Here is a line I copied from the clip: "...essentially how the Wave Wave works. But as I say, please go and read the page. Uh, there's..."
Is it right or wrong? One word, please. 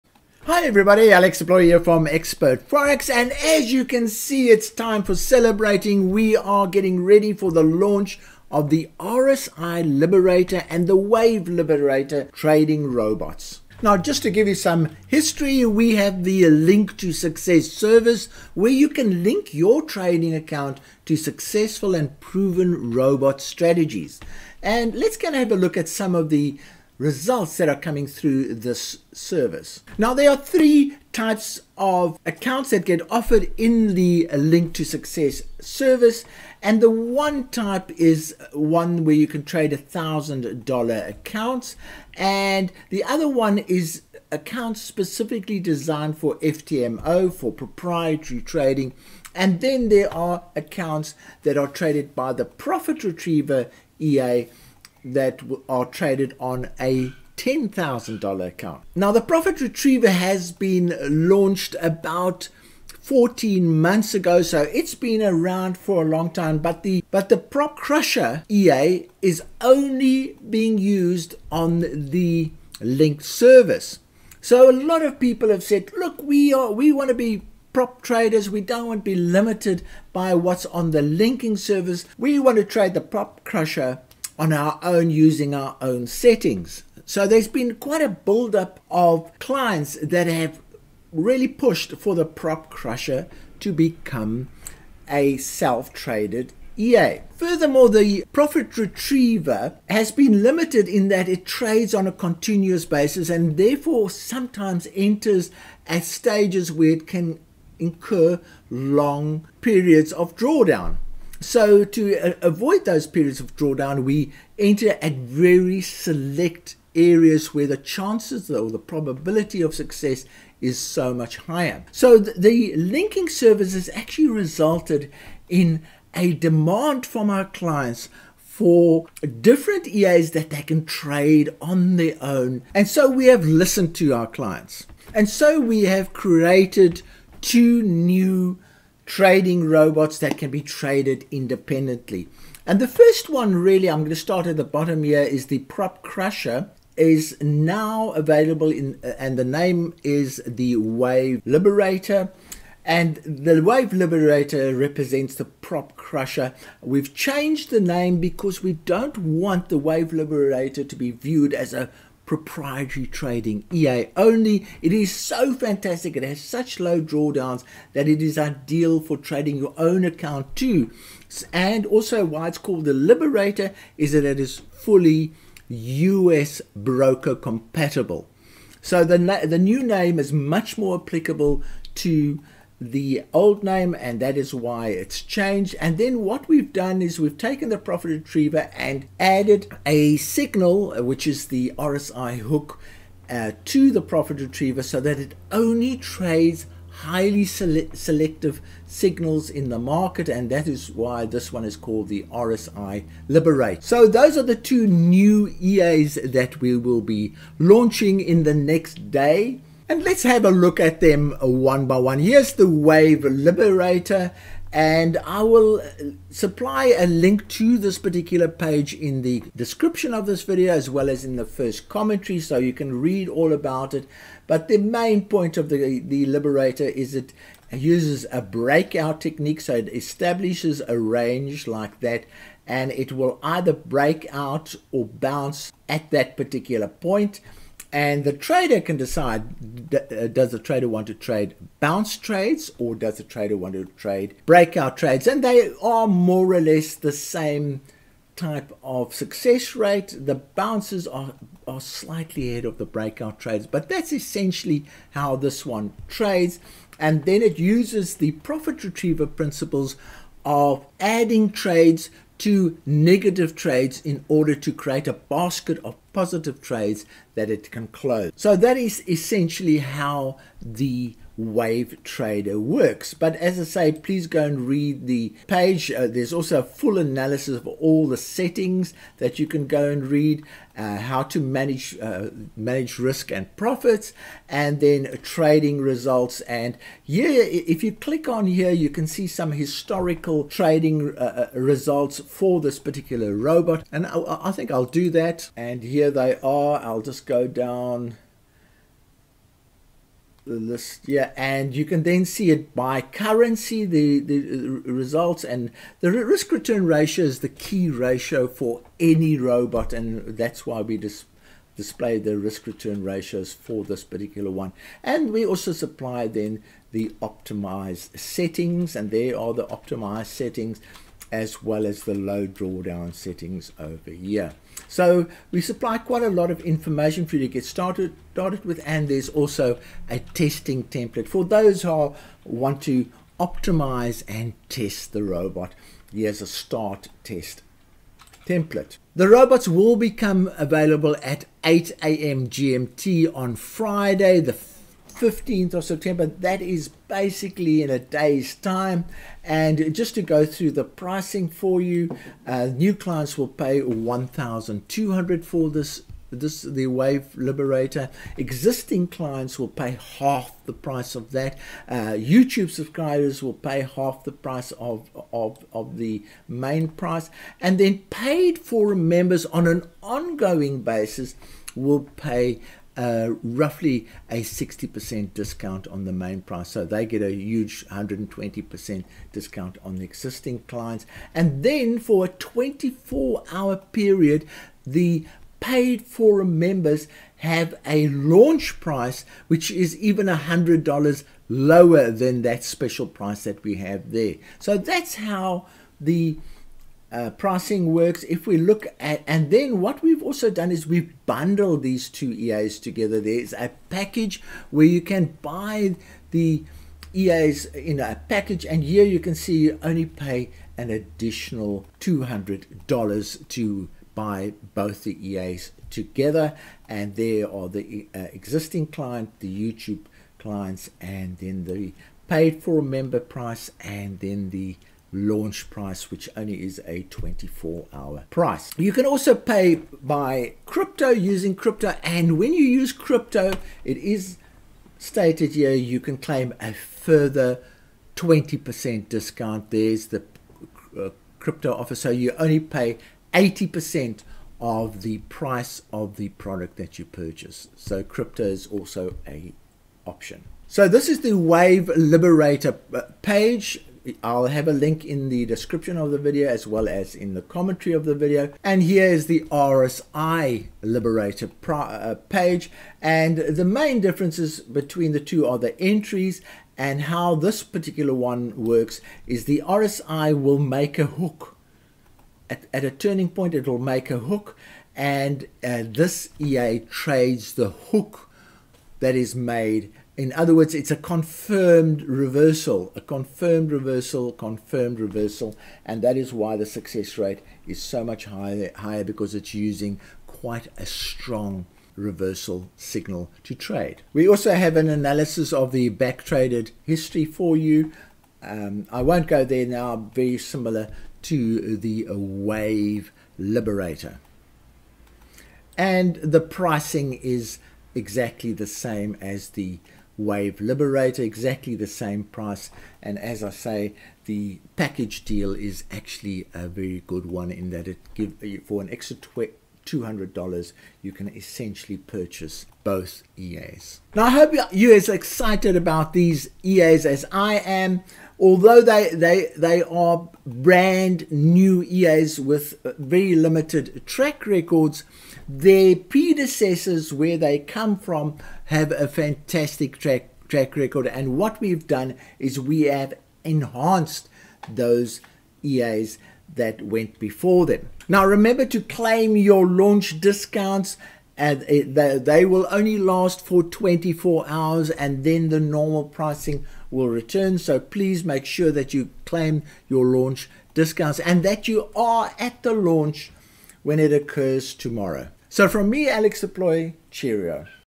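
wrong.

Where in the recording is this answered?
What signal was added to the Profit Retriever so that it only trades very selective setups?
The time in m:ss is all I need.
3:11.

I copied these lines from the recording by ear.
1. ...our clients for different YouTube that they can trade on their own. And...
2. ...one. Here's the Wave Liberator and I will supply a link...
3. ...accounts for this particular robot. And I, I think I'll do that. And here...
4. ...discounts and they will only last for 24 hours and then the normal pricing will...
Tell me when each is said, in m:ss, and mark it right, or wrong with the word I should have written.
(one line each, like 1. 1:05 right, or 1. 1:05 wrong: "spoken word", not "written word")
1. 2:07 wrong: "EAs", not "YouTube"
2. 3:31 right
3. 4:51 wrong: "results", not "accounts"
4. 9:10 right.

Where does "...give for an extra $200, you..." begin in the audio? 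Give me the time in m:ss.
8:38.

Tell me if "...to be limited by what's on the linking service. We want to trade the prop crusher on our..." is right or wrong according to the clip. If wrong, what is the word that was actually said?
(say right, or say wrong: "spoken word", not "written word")
right.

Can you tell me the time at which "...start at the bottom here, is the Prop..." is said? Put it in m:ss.
2:24.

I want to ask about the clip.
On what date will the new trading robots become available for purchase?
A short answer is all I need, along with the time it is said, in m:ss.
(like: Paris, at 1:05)
Friday 15 September, at 5:43.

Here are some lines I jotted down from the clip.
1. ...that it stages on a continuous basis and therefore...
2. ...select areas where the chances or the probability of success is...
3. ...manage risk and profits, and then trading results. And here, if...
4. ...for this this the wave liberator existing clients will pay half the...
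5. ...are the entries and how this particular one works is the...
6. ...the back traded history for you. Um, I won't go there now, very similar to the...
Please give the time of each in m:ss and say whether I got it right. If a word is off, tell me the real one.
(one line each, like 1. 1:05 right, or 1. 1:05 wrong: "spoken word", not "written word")
1. 1:41 wrong: "trades", not "stages"
2. 1:55 right
3. 4:42 right
4. 5:55 right
5. 7:45 right
6. 8:15 right.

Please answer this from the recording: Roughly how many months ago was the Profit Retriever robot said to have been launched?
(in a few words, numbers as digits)
14 months.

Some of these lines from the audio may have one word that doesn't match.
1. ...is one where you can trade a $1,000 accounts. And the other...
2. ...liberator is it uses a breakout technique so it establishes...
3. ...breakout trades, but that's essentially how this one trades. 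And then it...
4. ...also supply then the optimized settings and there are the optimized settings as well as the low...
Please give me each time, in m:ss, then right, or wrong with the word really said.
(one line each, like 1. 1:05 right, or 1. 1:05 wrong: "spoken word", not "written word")
1. 0:37 right
2. 3:46 right
3. 4:12 right
4. 5:15 right.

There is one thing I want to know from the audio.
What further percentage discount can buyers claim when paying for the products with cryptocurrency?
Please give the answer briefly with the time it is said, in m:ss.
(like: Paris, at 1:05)
20%, at 7:18.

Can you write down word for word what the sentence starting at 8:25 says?
And the pricing is exactly the same as the Wave Liberator, exactly the same price.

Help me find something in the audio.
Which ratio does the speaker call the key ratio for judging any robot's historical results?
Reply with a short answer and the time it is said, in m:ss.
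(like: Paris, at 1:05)
Risk return ratio, at 5:06.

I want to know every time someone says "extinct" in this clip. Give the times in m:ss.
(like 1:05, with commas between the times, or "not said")
not said.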